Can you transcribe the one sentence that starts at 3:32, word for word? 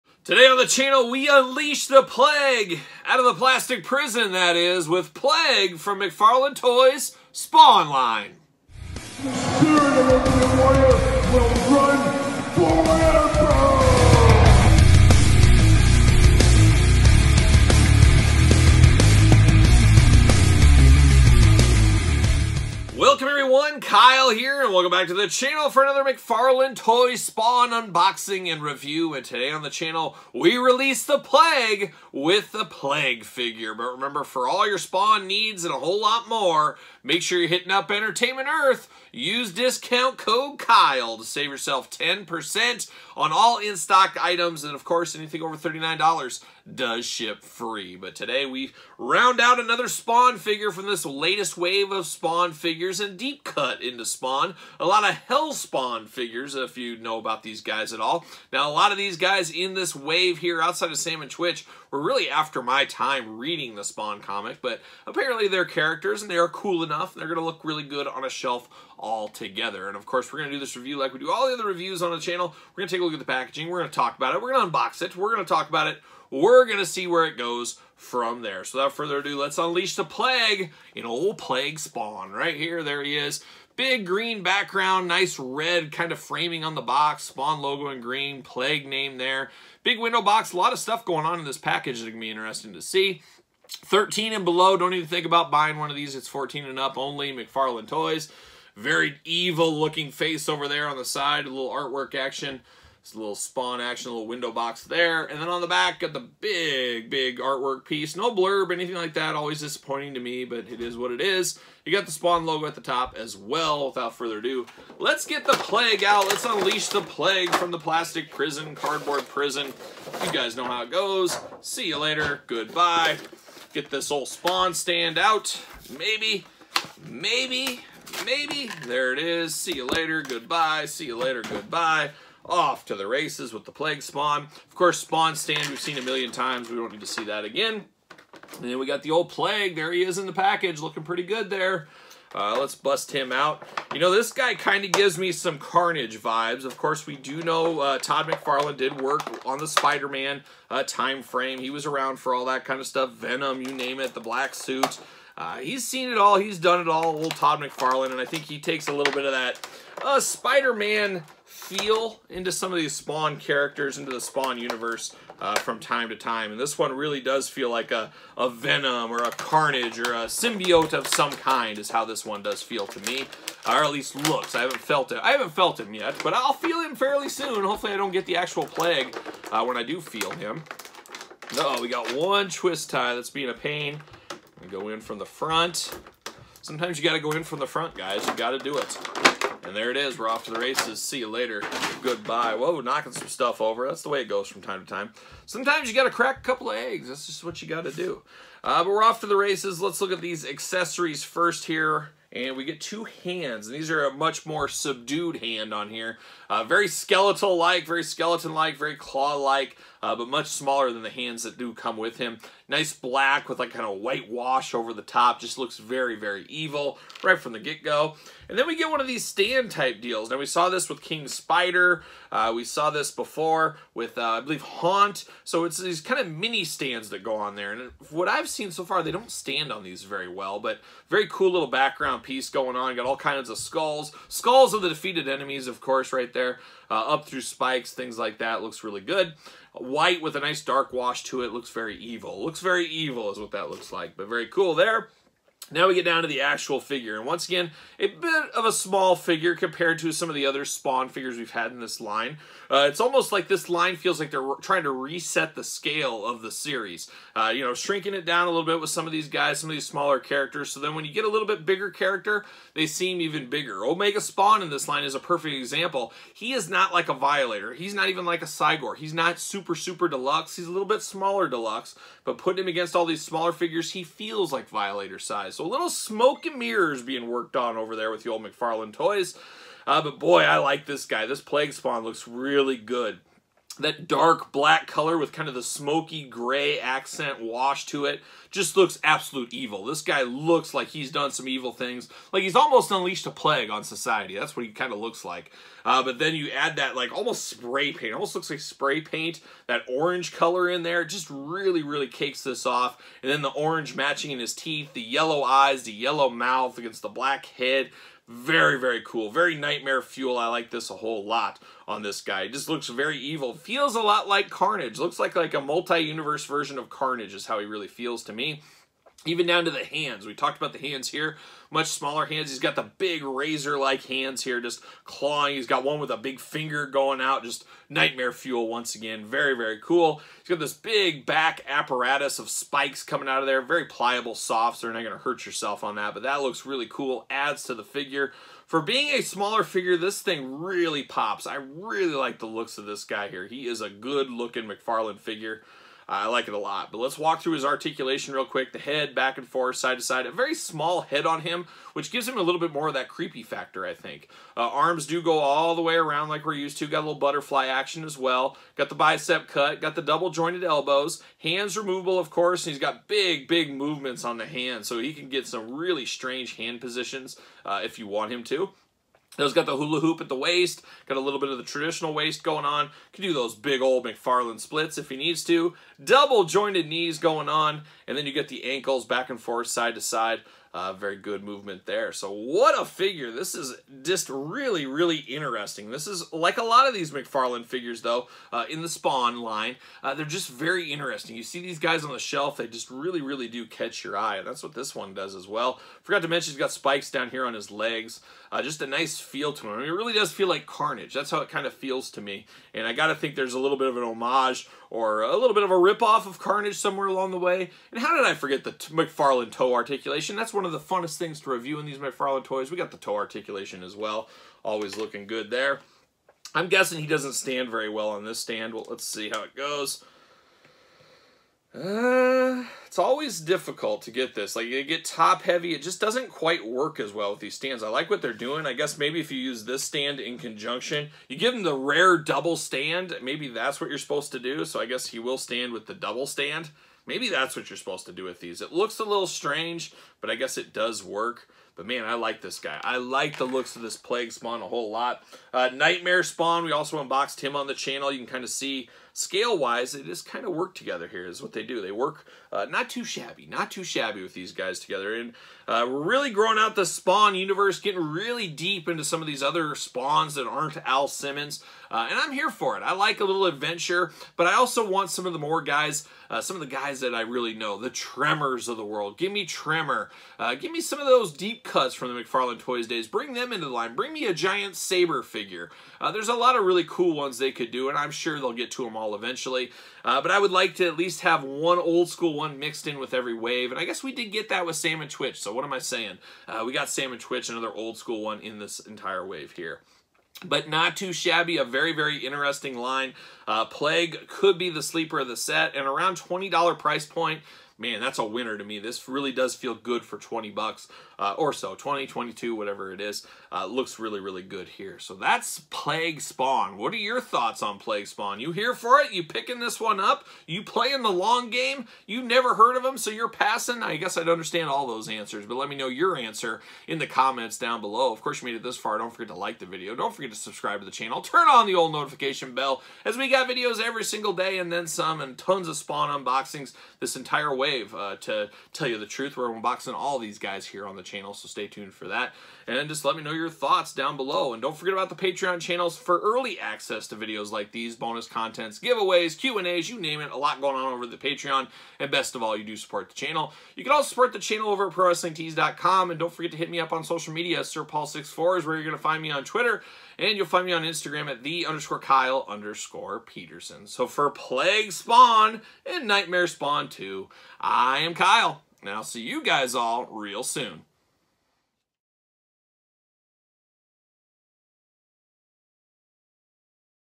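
Nice black with like kind of white wash over the top.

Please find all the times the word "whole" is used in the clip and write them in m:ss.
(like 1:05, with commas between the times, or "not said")
0:35, 5:10, 7:24.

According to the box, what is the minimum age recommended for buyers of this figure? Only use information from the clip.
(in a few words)
14.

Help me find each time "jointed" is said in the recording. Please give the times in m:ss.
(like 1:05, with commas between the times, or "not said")
6:00, 6:16.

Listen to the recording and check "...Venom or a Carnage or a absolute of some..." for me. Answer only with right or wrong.
wrong.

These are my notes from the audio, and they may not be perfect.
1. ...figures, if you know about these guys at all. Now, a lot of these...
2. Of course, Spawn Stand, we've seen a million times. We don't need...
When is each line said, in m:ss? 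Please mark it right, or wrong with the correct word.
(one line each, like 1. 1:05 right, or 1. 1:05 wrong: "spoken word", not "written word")
1. 0:56 right
2. 2:14 right.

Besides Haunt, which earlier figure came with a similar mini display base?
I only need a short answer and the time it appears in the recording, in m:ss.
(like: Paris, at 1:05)
King Spider, at 3:41.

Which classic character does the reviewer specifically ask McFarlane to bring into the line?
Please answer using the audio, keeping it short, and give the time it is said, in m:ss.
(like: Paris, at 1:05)
Tremor, at 7:49.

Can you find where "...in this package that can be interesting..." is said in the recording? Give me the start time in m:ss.
1:31.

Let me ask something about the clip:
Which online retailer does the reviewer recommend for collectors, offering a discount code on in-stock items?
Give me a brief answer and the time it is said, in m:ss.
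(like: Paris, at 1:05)
Entertainment Earth, at 0:37.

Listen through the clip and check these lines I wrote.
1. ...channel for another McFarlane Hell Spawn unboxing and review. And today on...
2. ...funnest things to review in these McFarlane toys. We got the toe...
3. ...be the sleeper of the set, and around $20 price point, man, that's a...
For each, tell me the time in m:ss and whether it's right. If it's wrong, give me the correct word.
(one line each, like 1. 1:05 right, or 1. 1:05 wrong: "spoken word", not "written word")
1. 0:25 wrong: "Toy", not "Hell"
2. 6:50 right
3. 8:14 right.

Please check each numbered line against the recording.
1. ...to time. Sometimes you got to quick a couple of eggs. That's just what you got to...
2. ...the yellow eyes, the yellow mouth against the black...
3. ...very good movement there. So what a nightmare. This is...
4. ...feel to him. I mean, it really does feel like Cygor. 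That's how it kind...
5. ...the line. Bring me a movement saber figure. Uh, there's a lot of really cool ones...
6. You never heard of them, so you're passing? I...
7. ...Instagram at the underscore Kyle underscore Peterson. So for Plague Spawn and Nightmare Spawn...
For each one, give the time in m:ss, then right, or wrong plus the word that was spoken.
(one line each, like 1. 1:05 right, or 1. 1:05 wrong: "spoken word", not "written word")
1. 3:14 wrong: "crack", not "quick"
2. 5:04 right
3. 6:20 wrong: "figure", not "nightmare"
4. 6:39 wrong: "Carnage", not "Cygor"
5. 7:53 wrong: "giant", not "movement"
6. 8:32 right
7. 9:10 right.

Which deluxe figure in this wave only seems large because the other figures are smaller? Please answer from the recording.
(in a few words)
Omega Spawn.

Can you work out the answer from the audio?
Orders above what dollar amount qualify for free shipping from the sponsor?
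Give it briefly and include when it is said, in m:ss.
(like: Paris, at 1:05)
$39, at 0:45.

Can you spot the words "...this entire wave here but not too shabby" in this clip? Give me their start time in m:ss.
8:08.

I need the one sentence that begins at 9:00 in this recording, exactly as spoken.
A lot going on over the Patreon.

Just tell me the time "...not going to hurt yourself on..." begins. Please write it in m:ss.
5:34.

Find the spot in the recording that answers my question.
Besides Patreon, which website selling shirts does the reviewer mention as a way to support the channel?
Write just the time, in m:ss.
9:04.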